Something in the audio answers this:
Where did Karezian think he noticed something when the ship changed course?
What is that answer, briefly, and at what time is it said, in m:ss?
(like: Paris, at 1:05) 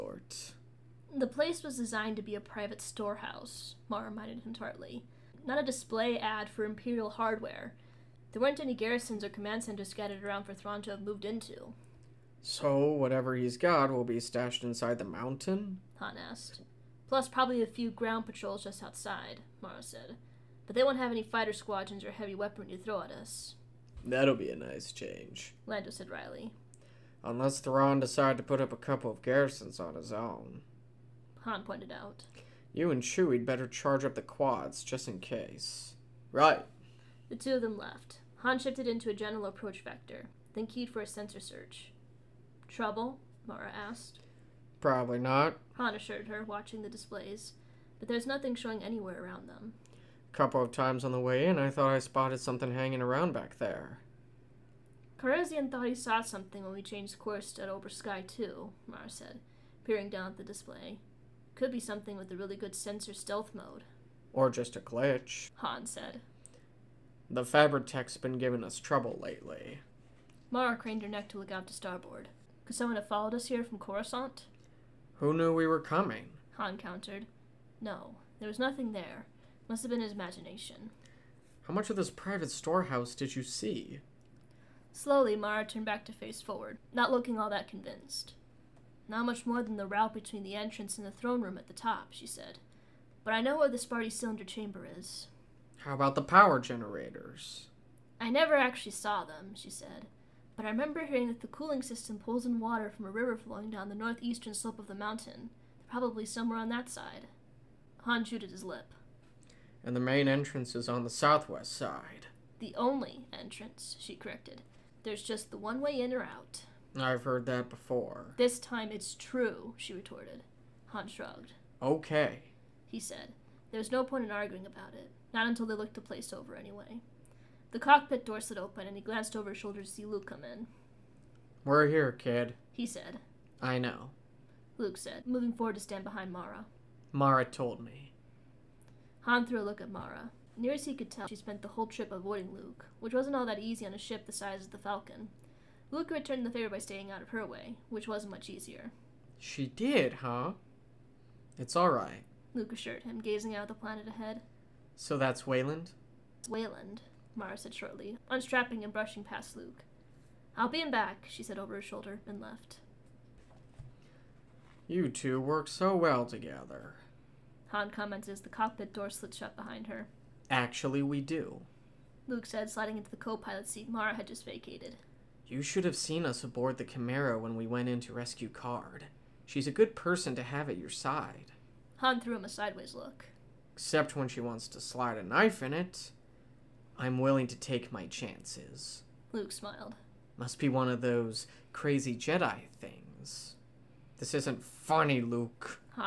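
Obroa-skai Two, at 0:57.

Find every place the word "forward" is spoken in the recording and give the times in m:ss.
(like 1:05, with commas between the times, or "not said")
1:26, 2:15.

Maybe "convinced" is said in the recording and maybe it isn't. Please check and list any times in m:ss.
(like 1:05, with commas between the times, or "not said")
1:27.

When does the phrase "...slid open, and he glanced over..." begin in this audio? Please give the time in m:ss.
2:08.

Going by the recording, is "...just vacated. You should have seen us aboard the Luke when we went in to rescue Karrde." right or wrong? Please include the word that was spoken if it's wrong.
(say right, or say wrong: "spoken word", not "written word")
wrong: "Chimera", not "Luke".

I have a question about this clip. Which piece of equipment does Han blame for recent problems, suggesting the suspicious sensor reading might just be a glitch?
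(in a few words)
The Fabritech.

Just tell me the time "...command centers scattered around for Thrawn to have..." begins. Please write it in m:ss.
0:09.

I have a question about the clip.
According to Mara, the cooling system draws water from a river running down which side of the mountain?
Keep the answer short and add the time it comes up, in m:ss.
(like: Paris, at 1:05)
Northeastern slope, at 1:43.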